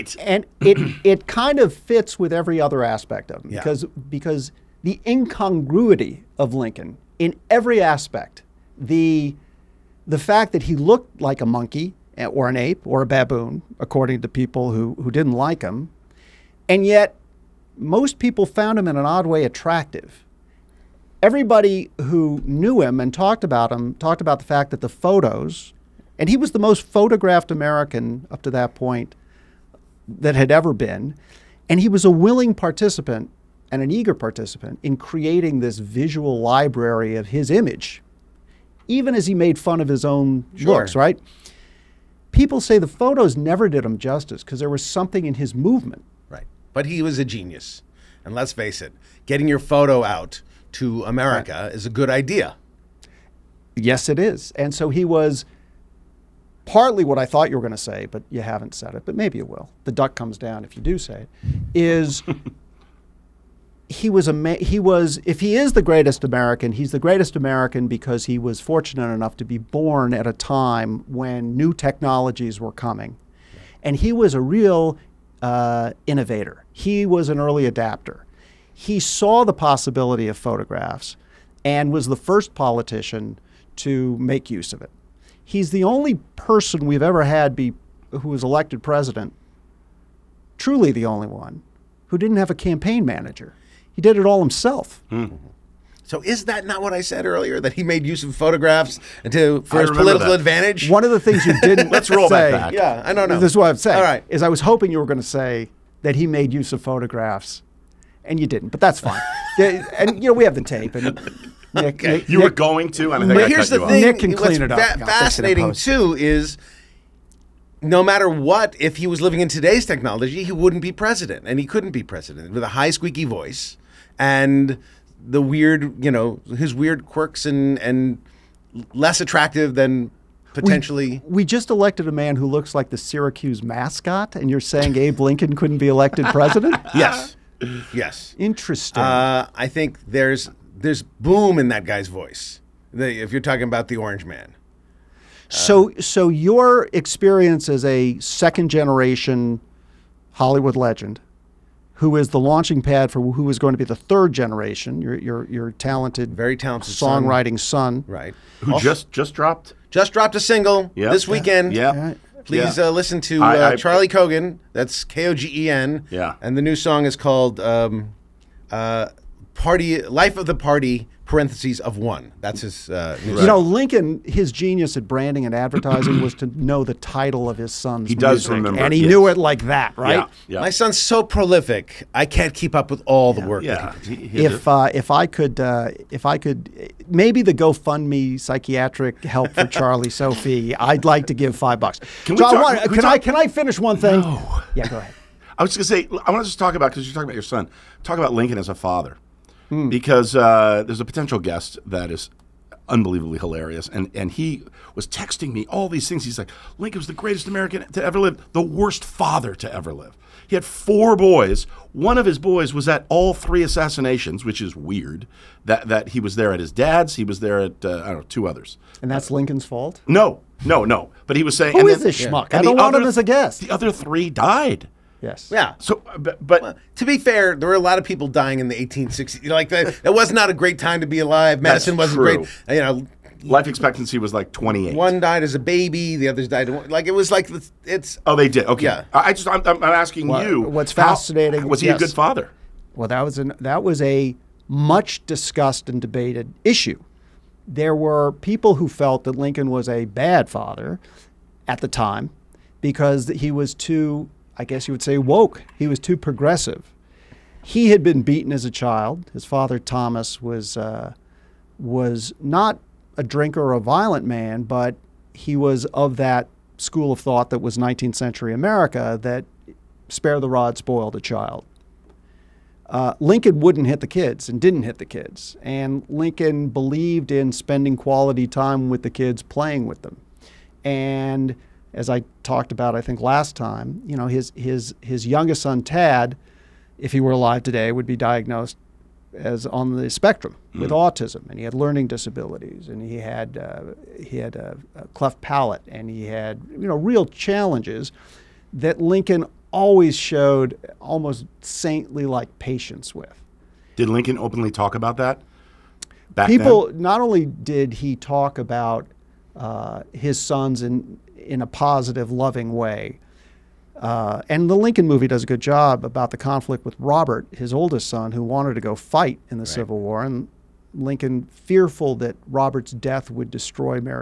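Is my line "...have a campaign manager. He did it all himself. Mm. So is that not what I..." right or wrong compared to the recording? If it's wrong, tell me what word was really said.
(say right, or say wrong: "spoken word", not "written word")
right.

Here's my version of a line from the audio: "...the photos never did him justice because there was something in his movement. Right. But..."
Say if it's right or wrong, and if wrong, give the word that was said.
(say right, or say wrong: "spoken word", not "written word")
right.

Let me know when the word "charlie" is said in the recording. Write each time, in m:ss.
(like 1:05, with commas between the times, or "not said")
2:43, 3:09.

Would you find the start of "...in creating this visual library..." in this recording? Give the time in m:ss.
0:34.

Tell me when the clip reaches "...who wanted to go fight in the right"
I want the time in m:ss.
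5:18.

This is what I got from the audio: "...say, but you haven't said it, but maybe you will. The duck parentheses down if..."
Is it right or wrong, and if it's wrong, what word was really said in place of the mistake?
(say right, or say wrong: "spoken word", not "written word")
wrong: "comes", not "parentheses".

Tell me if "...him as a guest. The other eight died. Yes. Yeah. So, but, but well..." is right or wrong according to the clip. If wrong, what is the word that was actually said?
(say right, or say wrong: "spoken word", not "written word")
wrong: "three", not "eight".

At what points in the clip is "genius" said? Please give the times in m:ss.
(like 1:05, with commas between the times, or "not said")
0:47, 2:54.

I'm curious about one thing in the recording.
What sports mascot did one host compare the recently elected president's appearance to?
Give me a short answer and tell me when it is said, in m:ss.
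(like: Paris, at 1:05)
Syracuse mascot, at 2:12.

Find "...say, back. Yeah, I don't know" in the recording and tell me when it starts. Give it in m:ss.
1:42.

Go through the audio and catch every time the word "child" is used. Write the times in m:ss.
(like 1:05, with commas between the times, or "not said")
4:18, 4:31.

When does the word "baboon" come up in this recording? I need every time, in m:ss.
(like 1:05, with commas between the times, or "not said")
0:13.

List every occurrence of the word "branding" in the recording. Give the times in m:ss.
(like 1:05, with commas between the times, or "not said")
2:55.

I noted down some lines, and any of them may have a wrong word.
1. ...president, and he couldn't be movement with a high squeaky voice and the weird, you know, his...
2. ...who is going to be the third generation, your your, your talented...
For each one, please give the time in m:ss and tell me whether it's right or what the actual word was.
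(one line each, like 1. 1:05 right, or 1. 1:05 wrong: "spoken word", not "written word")
1. 2:00 wrong: "president", not "movement"
2. 2:33 right.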